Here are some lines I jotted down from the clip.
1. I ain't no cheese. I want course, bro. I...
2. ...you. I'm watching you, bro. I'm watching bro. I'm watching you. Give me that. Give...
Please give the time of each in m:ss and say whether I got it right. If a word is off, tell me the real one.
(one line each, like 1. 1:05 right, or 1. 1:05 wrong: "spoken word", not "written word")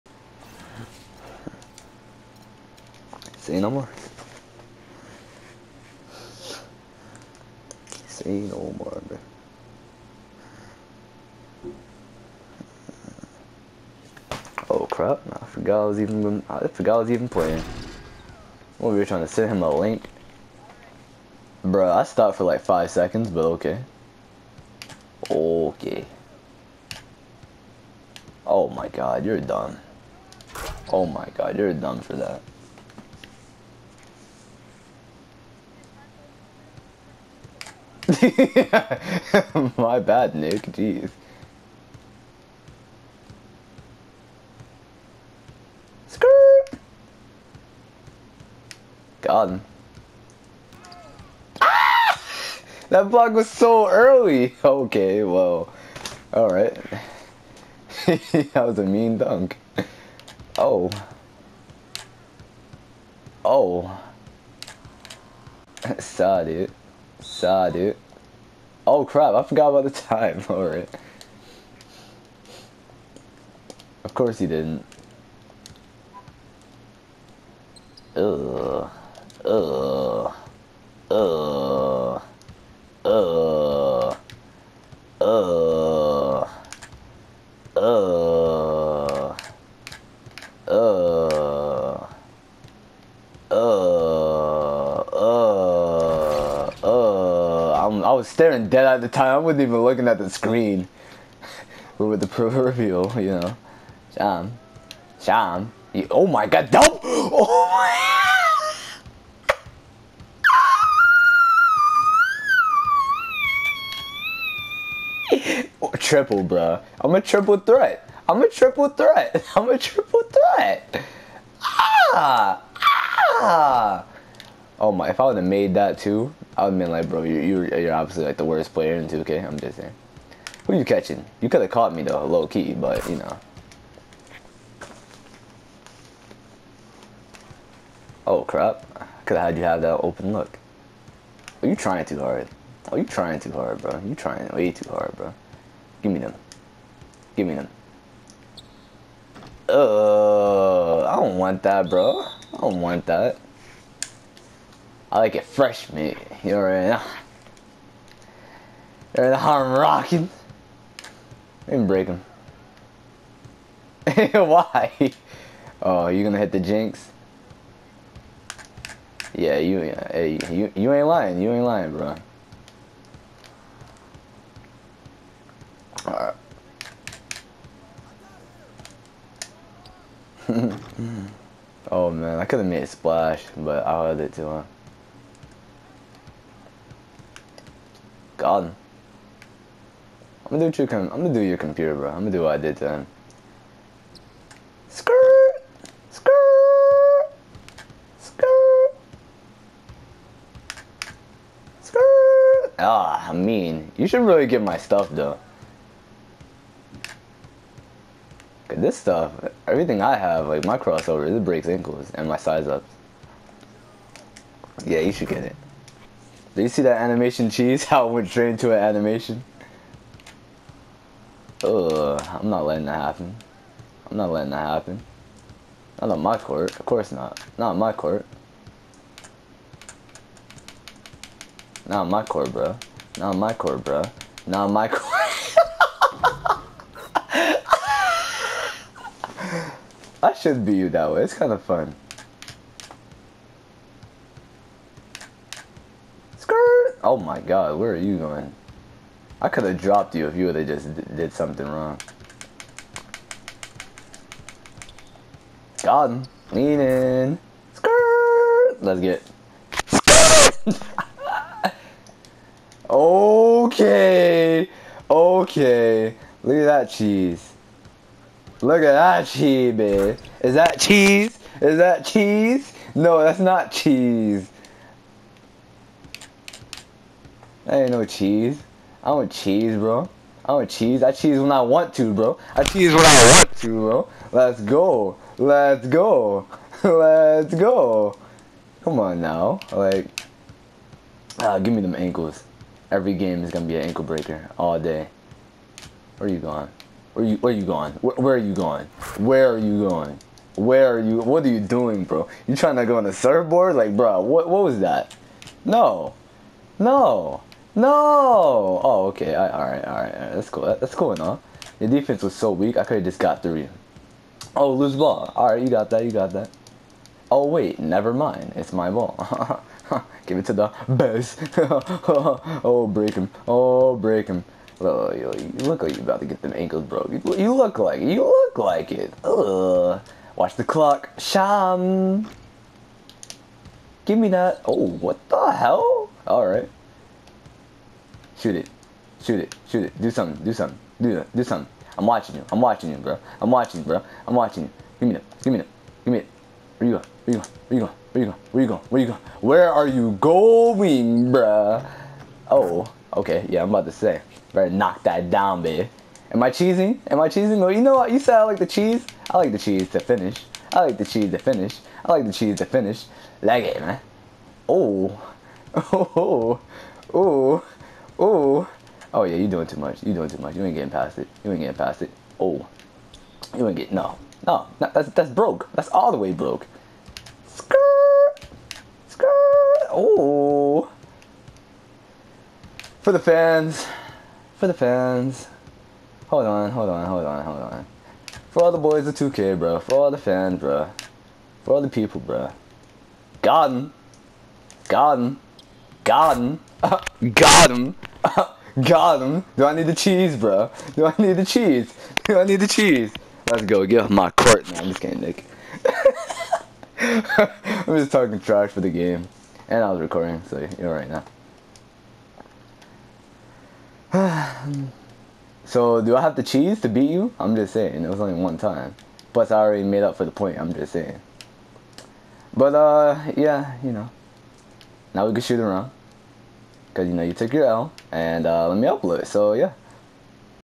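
1. 4:37 wrong: "cheese", not "course"
2. 5:42 right.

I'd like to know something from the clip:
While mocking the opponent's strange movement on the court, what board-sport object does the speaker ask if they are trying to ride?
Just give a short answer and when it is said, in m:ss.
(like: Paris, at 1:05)
surfboard, at 5:03.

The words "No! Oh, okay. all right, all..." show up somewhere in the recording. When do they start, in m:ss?
5:07.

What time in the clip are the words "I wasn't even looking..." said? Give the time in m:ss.
1:39.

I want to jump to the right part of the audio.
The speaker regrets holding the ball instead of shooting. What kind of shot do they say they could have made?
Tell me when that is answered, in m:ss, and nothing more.
3:02.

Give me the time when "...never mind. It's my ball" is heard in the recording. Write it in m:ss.
5:17.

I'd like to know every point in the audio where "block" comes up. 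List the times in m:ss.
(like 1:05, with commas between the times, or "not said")
0:53.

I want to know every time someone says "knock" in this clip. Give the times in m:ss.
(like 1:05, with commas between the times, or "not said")
5:54.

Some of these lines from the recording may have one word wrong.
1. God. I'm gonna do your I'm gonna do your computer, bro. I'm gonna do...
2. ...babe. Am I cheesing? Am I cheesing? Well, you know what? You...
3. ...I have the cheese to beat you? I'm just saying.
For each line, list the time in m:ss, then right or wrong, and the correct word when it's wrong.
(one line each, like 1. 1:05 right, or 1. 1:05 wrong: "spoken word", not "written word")
1. 3:08 right
2. 5:55 right
3. 6:56 right.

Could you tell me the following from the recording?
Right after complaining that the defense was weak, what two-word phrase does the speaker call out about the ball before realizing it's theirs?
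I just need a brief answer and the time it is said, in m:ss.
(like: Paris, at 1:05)
lose ball, at 5:14.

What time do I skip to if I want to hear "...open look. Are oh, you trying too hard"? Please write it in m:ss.
2:20.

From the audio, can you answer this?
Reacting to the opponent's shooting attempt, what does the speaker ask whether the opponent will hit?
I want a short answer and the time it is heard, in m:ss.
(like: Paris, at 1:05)
the jinx, at 2:46.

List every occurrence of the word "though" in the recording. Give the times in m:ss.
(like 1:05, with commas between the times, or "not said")
2:12, 3:25.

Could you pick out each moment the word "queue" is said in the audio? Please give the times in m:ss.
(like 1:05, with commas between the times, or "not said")
not said.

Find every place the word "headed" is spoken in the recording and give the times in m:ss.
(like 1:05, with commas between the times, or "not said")
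not said.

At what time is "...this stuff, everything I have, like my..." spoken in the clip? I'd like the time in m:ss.
3:28.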